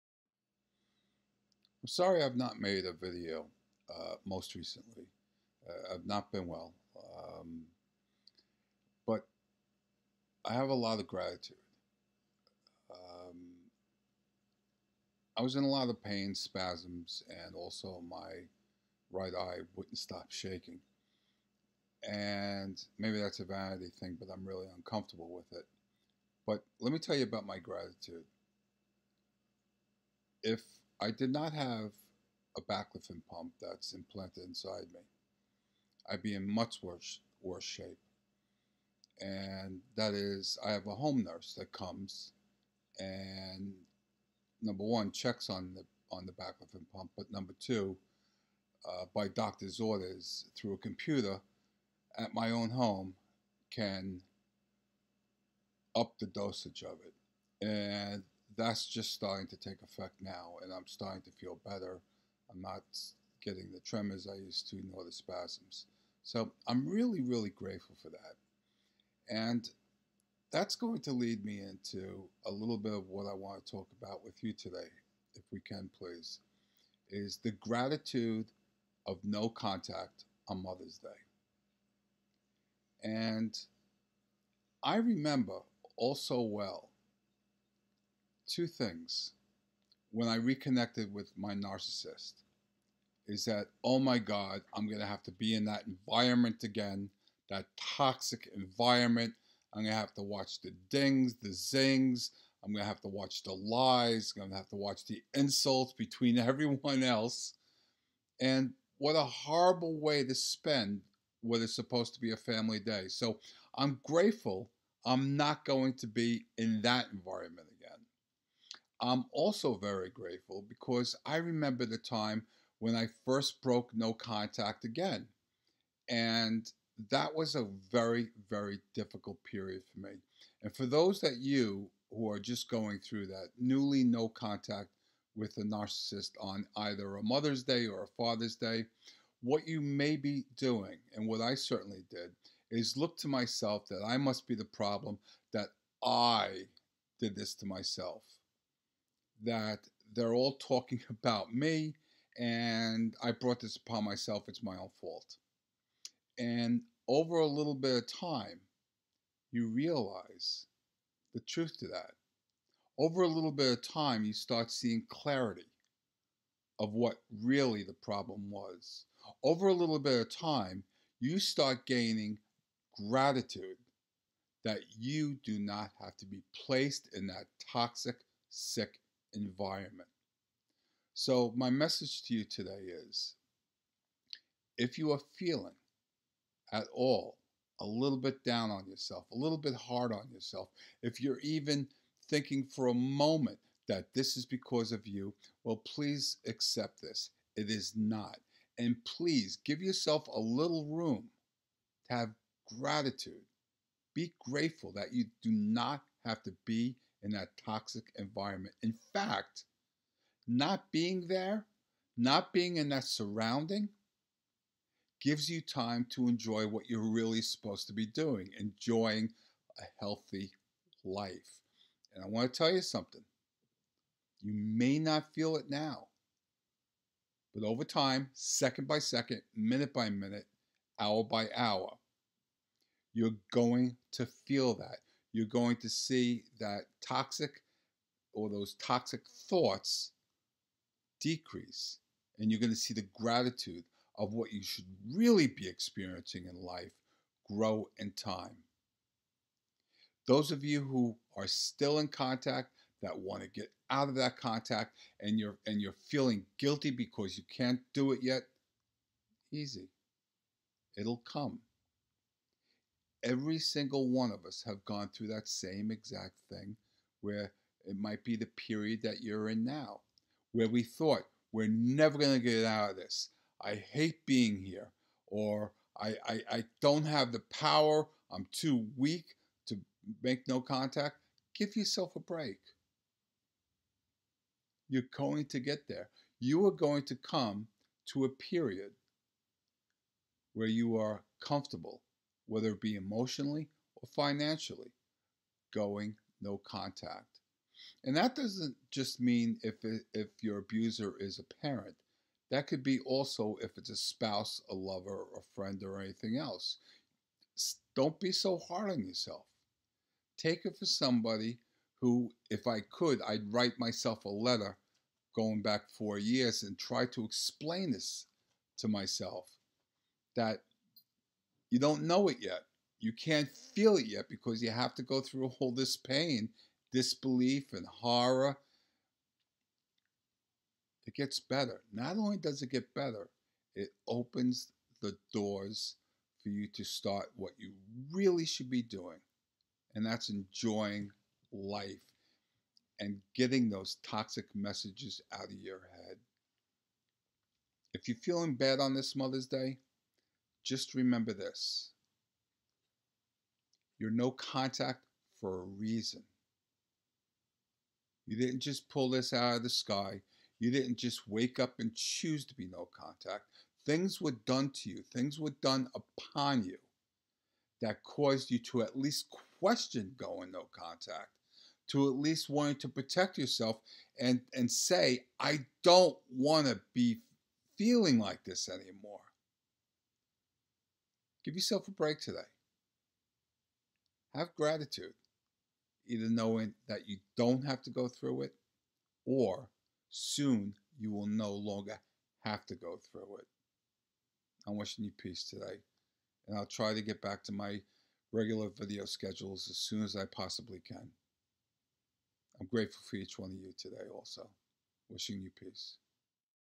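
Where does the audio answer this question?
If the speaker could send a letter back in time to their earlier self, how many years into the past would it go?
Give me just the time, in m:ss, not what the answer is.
5:15.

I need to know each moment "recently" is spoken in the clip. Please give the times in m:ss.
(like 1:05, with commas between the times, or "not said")
0:04.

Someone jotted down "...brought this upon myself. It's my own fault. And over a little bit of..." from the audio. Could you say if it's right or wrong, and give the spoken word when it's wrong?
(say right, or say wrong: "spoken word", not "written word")
right.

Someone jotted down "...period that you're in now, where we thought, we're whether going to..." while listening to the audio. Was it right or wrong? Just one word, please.
wrong.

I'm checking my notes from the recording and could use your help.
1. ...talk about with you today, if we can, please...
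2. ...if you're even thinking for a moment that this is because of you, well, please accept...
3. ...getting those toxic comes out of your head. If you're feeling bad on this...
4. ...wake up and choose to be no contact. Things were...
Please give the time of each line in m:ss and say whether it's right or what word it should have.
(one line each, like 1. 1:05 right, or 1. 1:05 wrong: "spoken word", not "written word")
1. 1:13 right
2. 3:11 right
3. 5:43 wrong: "messages", not "comes"
4. 6:01 right.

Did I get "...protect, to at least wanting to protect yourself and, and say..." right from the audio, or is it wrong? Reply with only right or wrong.
wrong.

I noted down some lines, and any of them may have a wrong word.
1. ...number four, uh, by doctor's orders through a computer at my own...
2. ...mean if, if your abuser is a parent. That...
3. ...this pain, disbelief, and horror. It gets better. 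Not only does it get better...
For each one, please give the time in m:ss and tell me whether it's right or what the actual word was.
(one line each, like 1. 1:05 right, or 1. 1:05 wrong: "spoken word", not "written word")
1. 0:47 wrong: "two", not "four"
2. 4:59 right
3. 5:25 right.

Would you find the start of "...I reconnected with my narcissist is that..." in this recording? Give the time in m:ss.
1:30.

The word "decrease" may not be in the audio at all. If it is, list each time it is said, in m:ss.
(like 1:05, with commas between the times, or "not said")
4:01.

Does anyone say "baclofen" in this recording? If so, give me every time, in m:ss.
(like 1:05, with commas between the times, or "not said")
0:32, 0:46.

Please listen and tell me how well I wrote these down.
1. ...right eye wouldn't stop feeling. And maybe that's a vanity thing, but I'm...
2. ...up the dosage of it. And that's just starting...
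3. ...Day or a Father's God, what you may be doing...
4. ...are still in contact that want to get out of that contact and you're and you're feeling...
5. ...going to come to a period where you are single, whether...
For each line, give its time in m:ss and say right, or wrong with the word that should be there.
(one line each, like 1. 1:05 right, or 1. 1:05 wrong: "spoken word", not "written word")
1. 0:19 wrong: "shaking", not "feeling"
2. 0:55 right
3. 2:17 wrong: "Day", not "God"
4. 4:11 right
5. 4:46 wrong: "comfortable", not "single".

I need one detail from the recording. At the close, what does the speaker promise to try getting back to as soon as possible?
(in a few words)
Regular video schedules.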